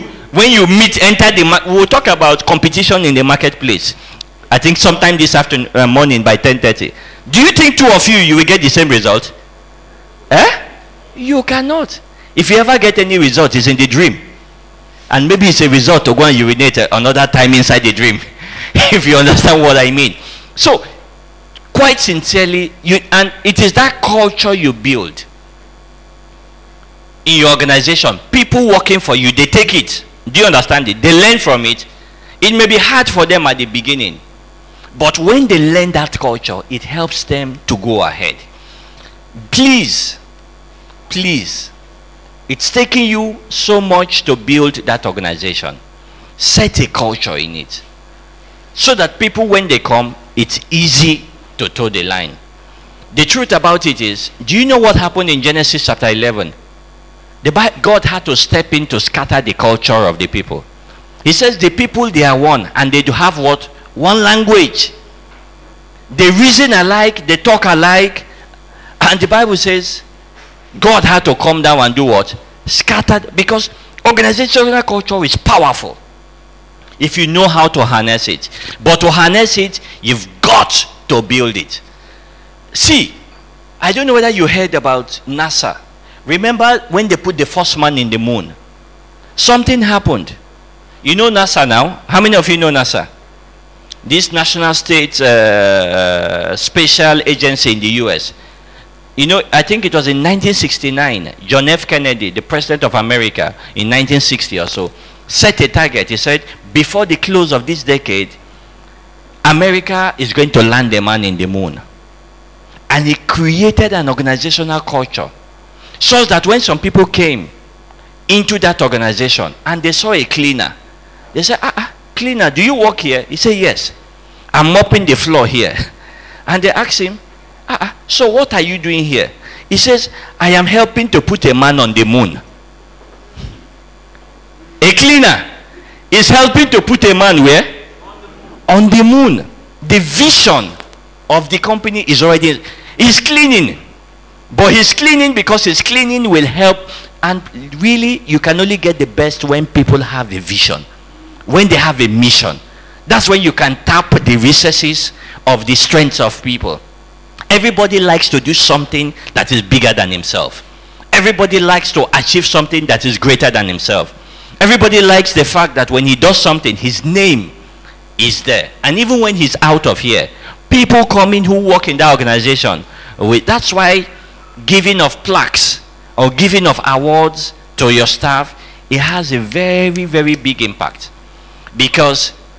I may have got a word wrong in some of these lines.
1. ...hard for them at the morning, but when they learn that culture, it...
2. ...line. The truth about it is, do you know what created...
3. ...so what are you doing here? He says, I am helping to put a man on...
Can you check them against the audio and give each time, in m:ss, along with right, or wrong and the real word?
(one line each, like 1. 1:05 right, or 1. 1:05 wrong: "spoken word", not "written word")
1. 0:32 wrong: "beginning", not "morning"
2. 0:52 wrong: "happened", not "created"
3. 2:08 right.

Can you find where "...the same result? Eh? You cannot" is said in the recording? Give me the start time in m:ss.
0:08.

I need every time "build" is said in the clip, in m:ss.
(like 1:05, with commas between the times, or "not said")
0:24, 0:44, 1:21.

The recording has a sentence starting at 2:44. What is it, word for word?
Everybody likes the fact that when he does something, his name is there.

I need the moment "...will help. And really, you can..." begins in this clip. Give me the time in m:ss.
2:26.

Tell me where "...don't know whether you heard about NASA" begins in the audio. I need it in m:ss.
1:23.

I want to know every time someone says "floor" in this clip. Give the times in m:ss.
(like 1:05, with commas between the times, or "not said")
2:05.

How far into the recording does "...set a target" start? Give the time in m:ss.
1:45.